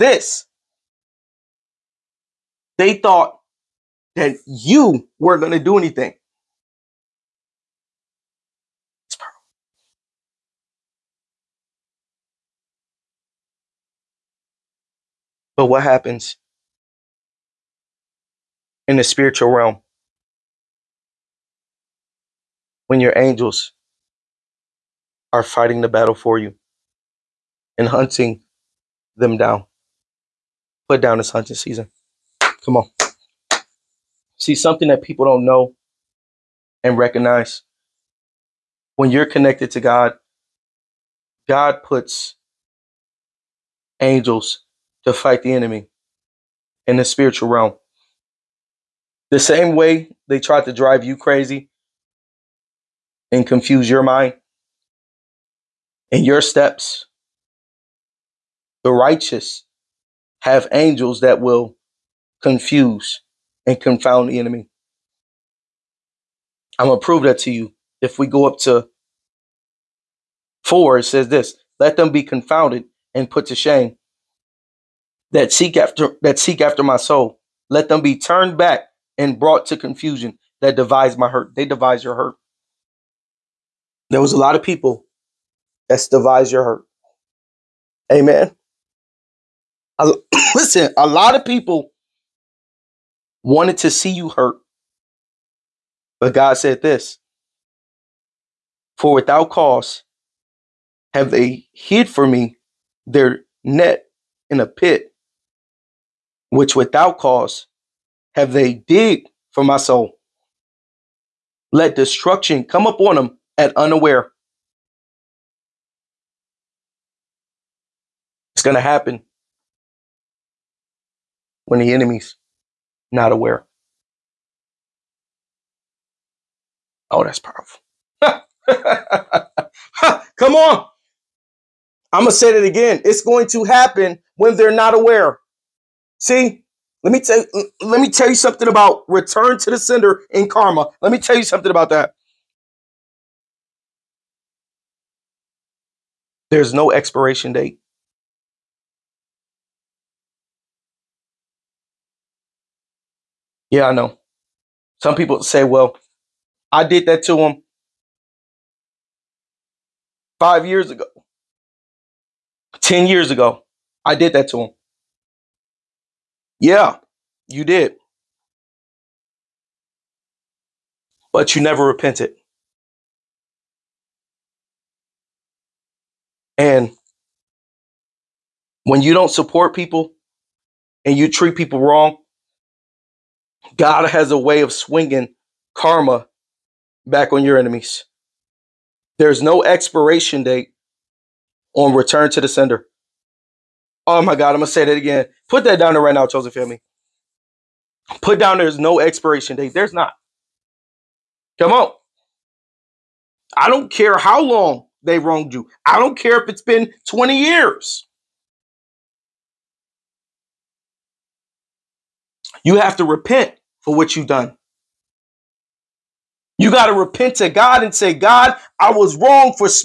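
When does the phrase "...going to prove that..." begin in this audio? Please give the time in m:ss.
1:06.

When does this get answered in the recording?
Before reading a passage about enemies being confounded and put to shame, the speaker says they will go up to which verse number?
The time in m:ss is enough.
1:10.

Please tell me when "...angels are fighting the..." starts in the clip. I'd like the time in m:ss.
0:23.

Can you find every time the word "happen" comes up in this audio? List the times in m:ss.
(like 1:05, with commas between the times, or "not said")
0:15, 1:58, 2:13.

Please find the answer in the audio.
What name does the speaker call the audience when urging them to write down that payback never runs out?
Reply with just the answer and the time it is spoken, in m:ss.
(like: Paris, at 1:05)
Chosen family, at 3:16.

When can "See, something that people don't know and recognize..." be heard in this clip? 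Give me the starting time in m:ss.
0:34.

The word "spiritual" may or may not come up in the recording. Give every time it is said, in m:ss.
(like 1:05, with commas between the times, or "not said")
0:19, 0:47.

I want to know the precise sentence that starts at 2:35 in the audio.
Some people say, well, I did that to him five years ago, 10 years ago.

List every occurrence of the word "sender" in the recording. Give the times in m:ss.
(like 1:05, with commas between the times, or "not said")
2:19, 3:12.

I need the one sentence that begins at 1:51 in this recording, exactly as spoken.
Let destruction come upon them at unaware.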